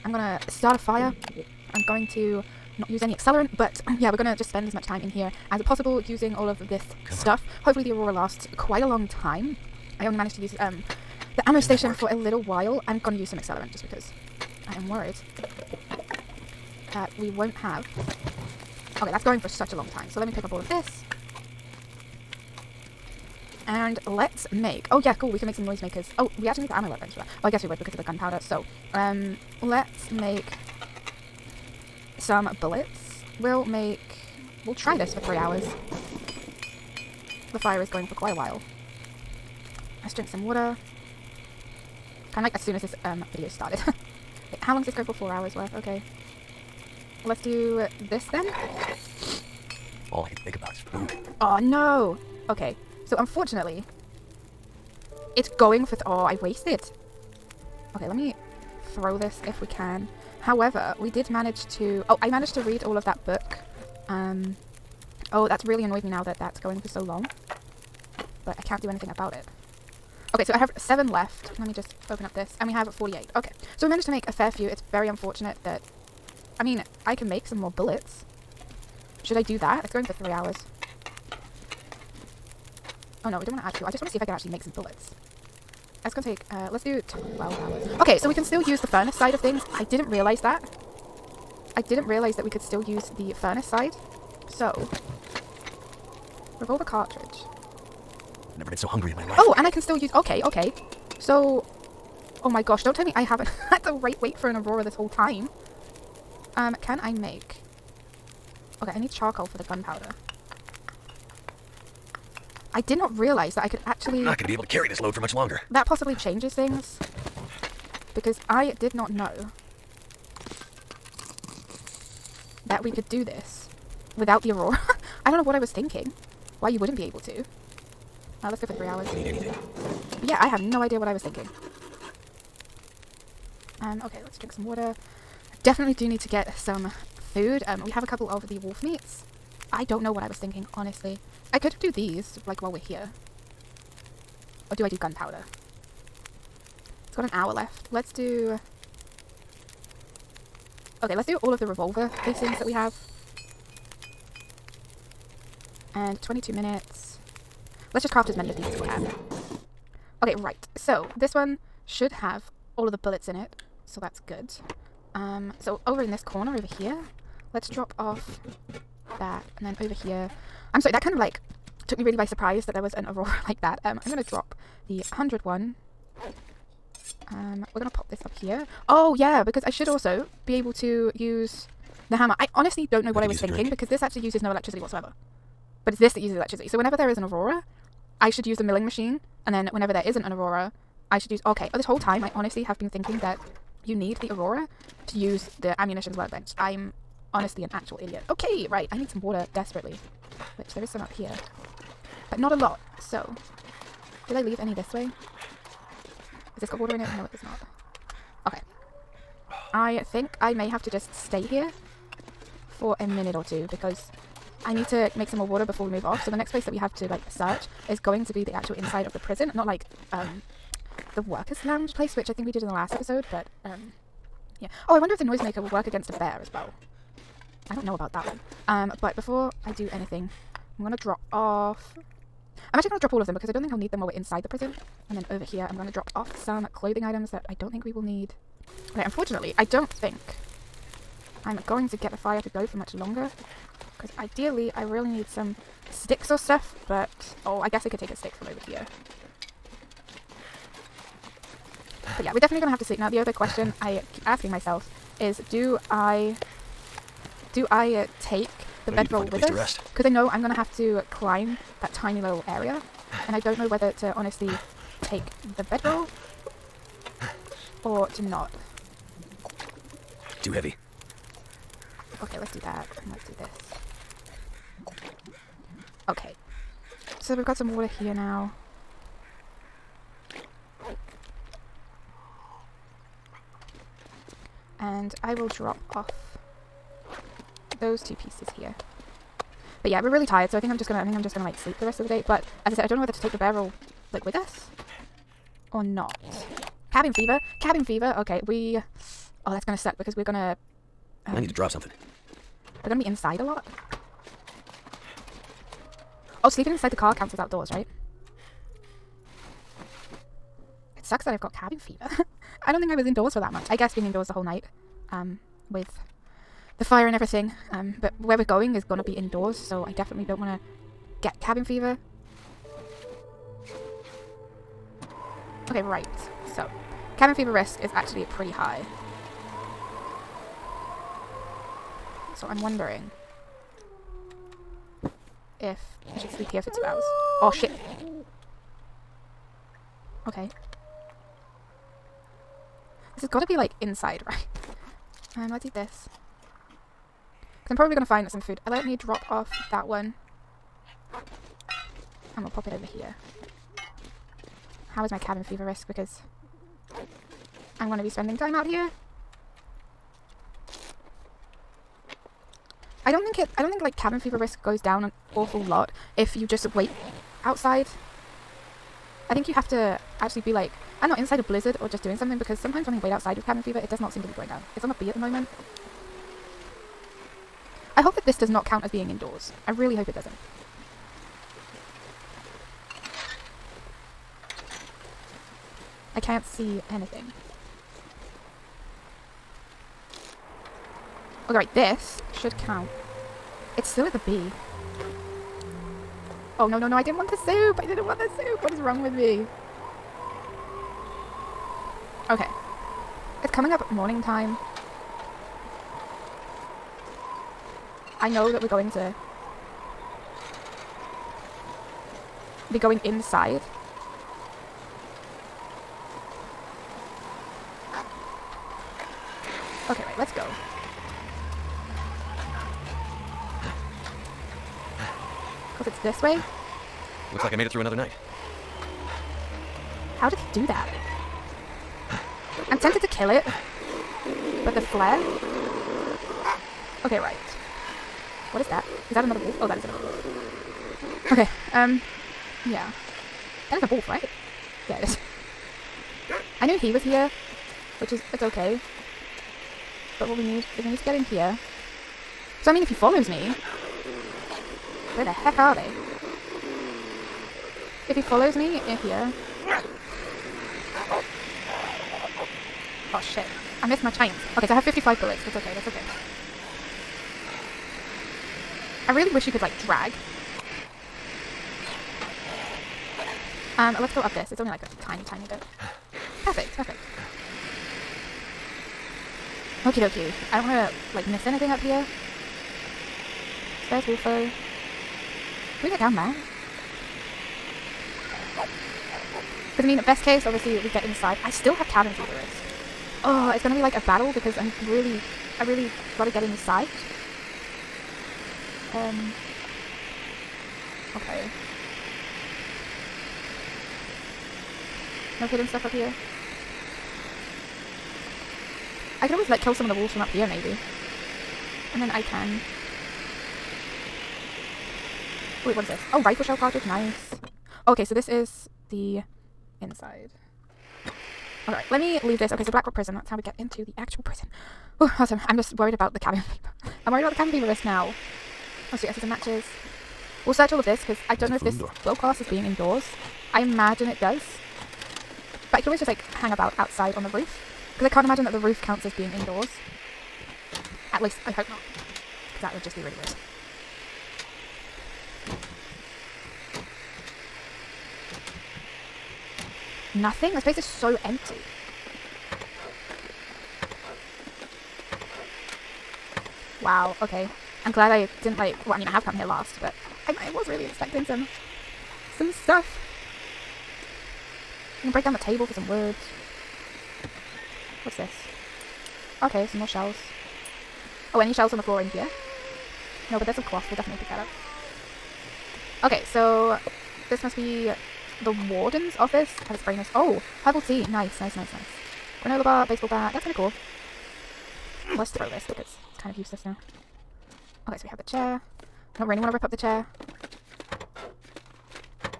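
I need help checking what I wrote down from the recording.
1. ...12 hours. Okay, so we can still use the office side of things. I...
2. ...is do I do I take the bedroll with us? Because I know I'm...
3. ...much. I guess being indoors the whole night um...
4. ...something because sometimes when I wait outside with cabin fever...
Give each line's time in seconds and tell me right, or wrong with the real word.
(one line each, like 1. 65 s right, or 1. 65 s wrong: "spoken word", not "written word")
1. 87 s wrong: "furnace", not "office"
2. 255 s right
3. 313 s right
4. 372 s right.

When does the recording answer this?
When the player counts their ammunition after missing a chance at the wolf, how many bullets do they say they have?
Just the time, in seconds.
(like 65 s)
464 s.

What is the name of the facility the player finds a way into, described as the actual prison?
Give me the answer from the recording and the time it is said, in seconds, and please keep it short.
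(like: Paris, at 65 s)
Blackrock Prison, at 522 s.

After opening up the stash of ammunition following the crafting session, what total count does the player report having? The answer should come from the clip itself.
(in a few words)
48.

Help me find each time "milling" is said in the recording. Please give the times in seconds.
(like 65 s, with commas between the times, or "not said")
188 s.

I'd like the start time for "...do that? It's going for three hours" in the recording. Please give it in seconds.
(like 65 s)
79 s.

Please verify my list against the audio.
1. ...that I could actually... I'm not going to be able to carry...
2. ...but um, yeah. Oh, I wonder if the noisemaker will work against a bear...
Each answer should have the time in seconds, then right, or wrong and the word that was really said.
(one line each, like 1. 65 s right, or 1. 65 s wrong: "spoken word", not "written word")
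1. 113 s right
2. 223 s right.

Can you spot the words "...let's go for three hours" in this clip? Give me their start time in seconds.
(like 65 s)
128 s.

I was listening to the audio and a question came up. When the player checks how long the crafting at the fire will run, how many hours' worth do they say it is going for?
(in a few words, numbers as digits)
4.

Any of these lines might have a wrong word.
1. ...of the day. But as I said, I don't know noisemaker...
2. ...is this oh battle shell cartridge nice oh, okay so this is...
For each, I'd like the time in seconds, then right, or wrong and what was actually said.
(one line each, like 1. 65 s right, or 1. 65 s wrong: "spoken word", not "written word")
1. 291 s wrong: "whether", not "noisemaker"
2. 515 s wrong: "rifle", not "battle".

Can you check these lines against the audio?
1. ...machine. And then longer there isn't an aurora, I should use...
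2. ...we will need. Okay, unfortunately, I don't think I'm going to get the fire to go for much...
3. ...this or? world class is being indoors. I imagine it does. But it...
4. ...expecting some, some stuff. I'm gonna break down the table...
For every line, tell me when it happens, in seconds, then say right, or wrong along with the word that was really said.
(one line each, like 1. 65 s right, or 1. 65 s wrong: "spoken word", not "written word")
1. 188 s wrong: "whenever", not "longer"
2. 237 s right
3. 531 s right
4. 560 s right.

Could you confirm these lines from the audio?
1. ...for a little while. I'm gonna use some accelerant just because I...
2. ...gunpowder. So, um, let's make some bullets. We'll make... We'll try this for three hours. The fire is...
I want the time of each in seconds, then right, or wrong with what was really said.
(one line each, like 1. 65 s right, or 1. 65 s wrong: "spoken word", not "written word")
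1. 11 s right
2. 28 s right.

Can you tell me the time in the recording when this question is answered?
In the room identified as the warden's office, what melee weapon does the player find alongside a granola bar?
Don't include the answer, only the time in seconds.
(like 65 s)
582 s.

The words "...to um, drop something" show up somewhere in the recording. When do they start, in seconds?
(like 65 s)
301 s.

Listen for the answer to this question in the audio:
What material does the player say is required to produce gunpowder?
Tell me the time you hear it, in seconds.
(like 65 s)
109 s.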